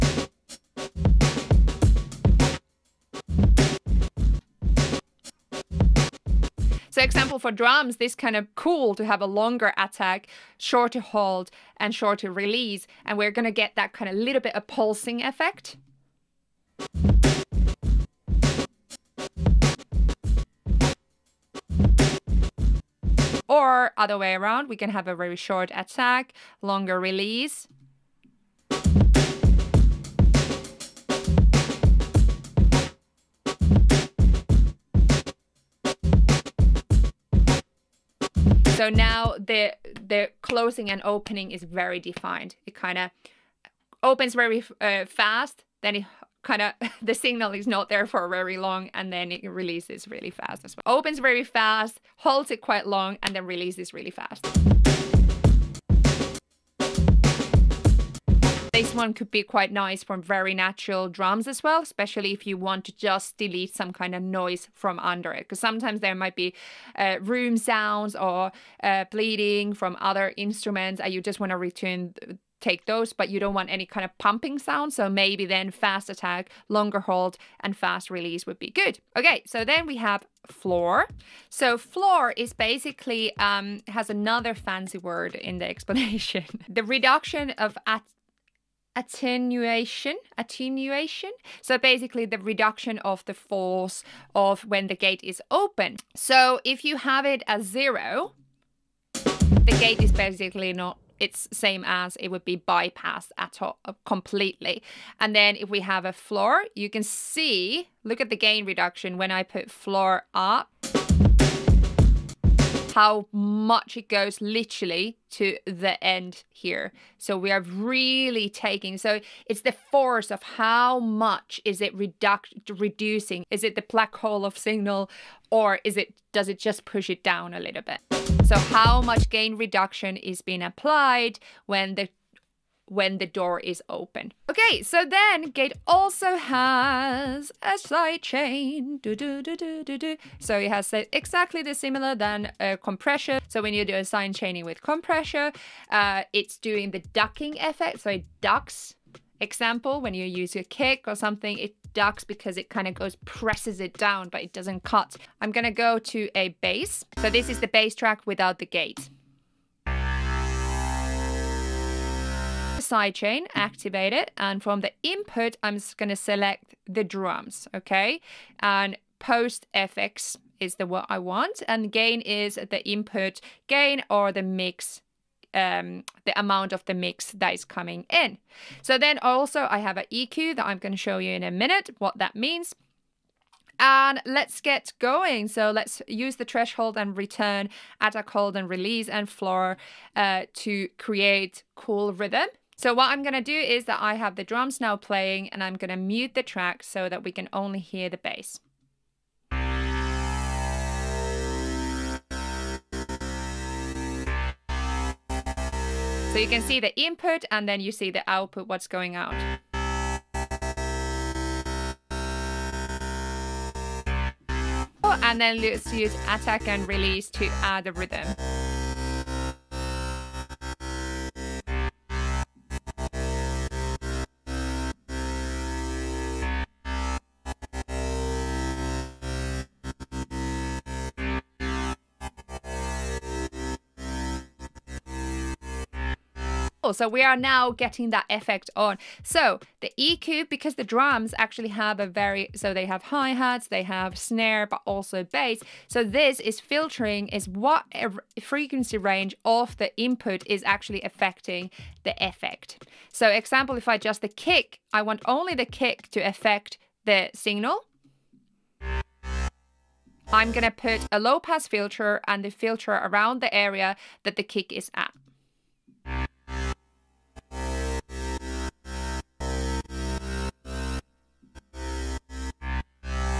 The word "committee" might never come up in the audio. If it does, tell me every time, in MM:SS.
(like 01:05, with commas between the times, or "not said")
not said.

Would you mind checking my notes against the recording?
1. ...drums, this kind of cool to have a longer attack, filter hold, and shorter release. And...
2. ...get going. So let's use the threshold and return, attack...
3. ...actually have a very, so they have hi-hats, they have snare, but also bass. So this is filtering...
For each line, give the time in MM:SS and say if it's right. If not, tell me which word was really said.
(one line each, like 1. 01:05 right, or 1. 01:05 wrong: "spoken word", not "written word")
1. 00:07 wrong: "shorter", not "filter"
2. 03:04 right
3. 04:01 right.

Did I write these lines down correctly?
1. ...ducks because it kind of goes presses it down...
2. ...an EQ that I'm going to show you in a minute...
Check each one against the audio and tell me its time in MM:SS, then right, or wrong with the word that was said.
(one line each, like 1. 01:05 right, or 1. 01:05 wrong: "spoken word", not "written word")
1. 02:31 right
2. 02:59 right.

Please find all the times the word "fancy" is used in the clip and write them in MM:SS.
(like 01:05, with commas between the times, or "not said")
01:24.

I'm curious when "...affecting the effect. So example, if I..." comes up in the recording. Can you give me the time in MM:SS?
04:11.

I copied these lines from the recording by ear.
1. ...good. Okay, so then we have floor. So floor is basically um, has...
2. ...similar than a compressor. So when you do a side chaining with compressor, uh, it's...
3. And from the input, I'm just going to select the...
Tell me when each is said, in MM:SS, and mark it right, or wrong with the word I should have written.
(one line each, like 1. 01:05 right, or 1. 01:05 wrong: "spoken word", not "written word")
1. 01:18 right
2. 02:21 right
3. 02:44 right.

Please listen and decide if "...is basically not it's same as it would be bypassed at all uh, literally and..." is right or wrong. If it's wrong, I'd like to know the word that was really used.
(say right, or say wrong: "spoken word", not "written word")
wrong: "completely", not "literally".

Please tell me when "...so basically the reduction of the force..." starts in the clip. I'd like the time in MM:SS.
01:31.